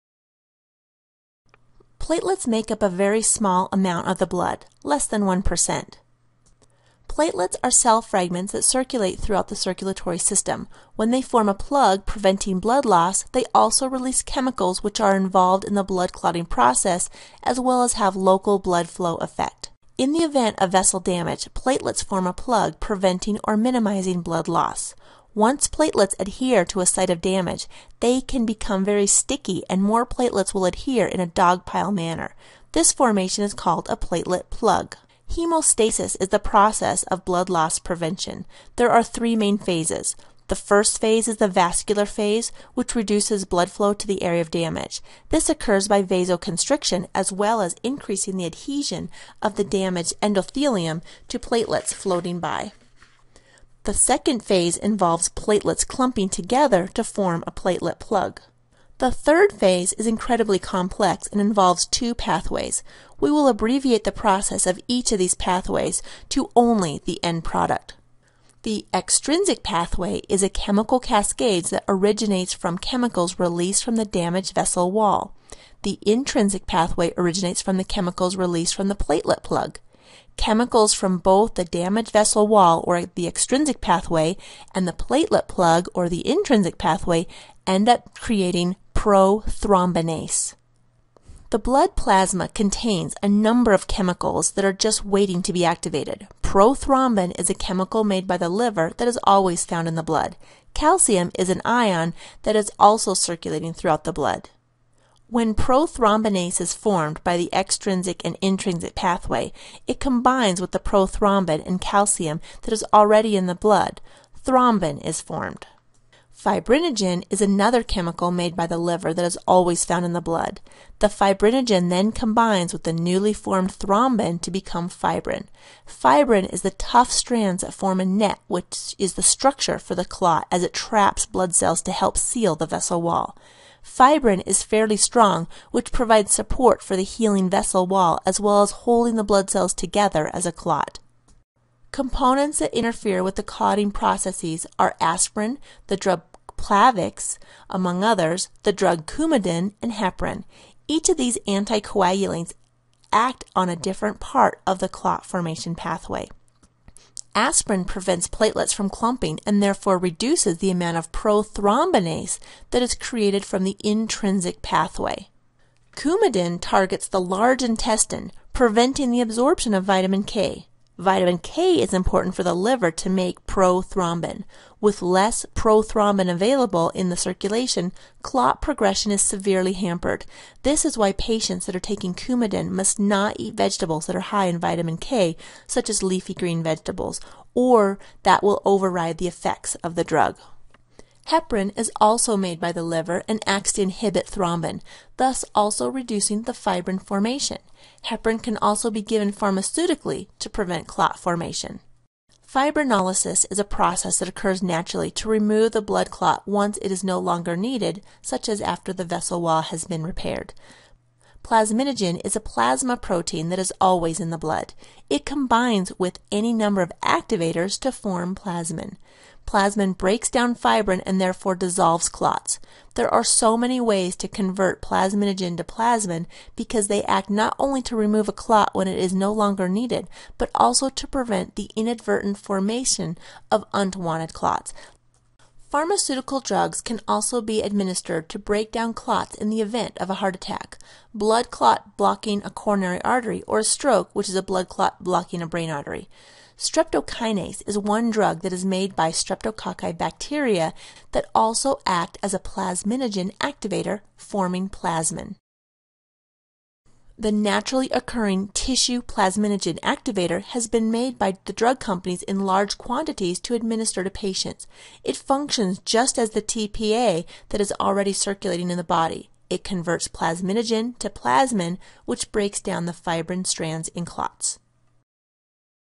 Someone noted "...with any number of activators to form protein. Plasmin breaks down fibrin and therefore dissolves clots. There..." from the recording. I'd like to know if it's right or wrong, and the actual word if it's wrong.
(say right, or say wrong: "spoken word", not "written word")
wrong: "plasmin", not "protein".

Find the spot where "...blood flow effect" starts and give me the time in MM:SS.
00:18.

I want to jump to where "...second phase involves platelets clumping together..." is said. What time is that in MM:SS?
00:53.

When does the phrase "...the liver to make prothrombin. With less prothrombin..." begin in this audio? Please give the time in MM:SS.
02:52.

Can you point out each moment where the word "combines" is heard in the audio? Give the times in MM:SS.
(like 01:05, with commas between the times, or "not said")
01:50, 02:02, 03:35.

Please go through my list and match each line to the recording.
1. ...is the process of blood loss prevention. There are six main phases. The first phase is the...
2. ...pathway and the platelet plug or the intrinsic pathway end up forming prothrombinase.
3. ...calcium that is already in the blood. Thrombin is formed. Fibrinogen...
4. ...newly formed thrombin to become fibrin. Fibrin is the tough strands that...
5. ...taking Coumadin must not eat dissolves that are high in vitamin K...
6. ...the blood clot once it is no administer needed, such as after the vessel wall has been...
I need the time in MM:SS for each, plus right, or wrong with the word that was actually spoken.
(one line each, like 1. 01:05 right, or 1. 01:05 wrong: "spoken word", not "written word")
1. 00:36 wrong: "three", not "six"
2. 01:23 wrong: "creating", not "forming"
3. 01:51 right
4. 02:02 right
5. 03:01 wrong: "vegetables", not "dissolves"
6. 03:25 wrong: "longer", not "administer".